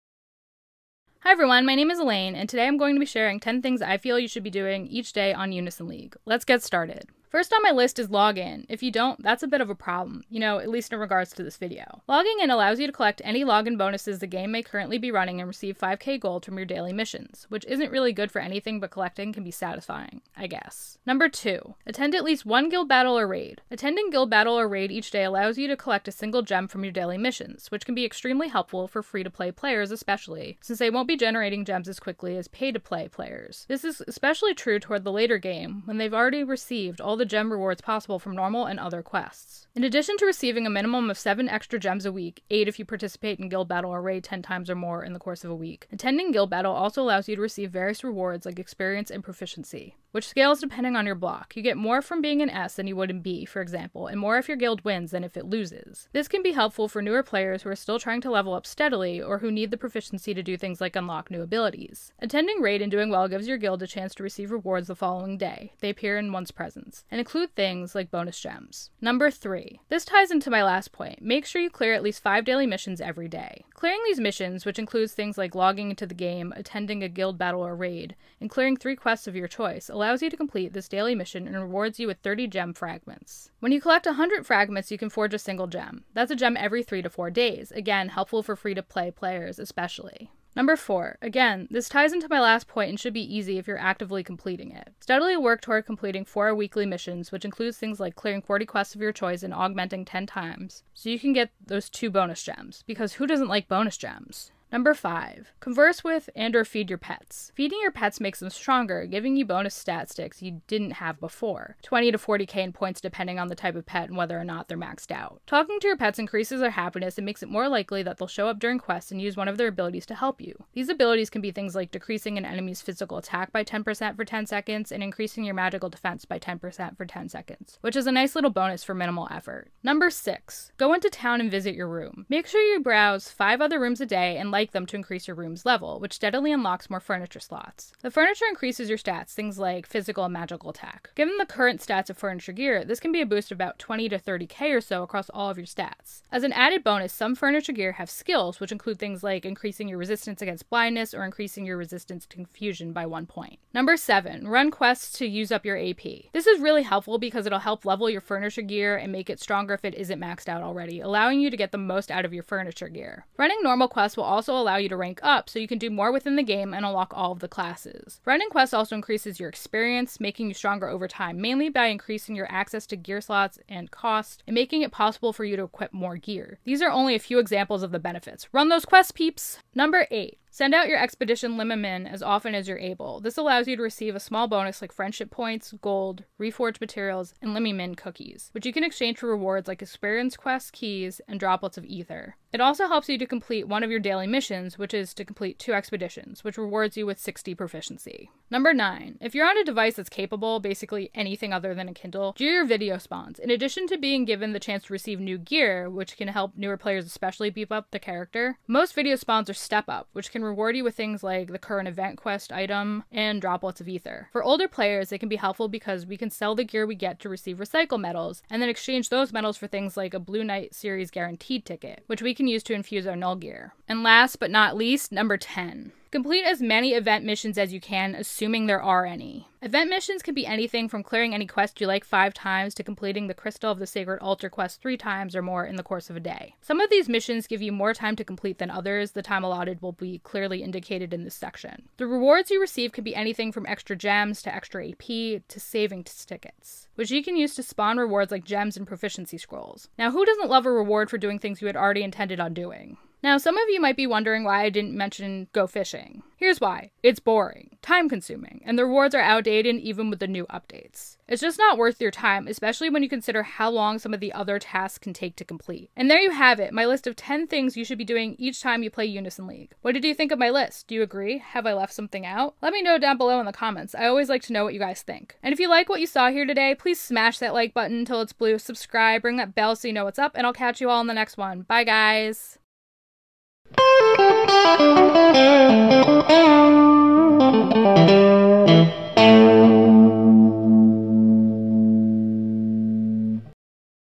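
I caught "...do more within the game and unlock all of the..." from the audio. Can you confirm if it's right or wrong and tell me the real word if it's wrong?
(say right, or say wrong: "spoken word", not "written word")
right.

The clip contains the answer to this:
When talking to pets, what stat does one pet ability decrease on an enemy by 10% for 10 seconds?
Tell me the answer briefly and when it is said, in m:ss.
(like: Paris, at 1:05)
Physical attack, at 2:02.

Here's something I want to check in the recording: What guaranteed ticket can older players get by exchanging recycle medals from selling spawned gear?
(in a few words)
Blue Knight series.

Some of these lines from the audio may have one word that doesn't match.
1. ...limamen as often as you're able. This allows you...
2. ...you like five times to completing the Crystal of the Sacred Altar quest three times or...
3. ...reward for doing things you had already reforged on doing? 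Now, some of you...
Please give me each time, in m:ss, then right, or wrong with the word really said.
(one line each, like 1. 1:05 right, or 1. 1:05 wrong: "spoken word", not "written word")
1. 3:01 right
2. 3:51 right
3. 4:10 wrong: "intended", not "reforged".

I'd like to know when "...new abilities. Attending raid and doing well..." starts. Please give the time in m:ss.
1:01.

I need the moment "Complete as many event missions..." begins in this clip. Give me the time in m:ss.
3:46.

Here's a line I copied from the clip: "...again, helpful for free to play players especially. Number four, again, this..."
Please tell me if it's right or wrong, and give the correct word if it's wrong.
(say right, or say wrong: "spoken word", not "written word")
right.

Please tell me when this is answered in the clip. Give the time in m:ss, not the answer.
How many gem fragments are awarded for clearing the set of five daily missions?
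1:22.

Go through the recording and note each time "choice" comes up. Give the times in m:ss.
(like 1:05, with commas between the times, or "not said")
1:19, 1:39.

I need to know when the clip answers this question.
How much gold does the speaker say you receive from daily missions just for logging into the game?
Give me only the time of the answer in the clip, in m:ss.
0:15.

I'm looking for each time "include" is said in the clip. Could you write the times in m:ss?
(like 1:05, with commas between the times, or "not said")
1:07, 1:14, 1:37, 2:28.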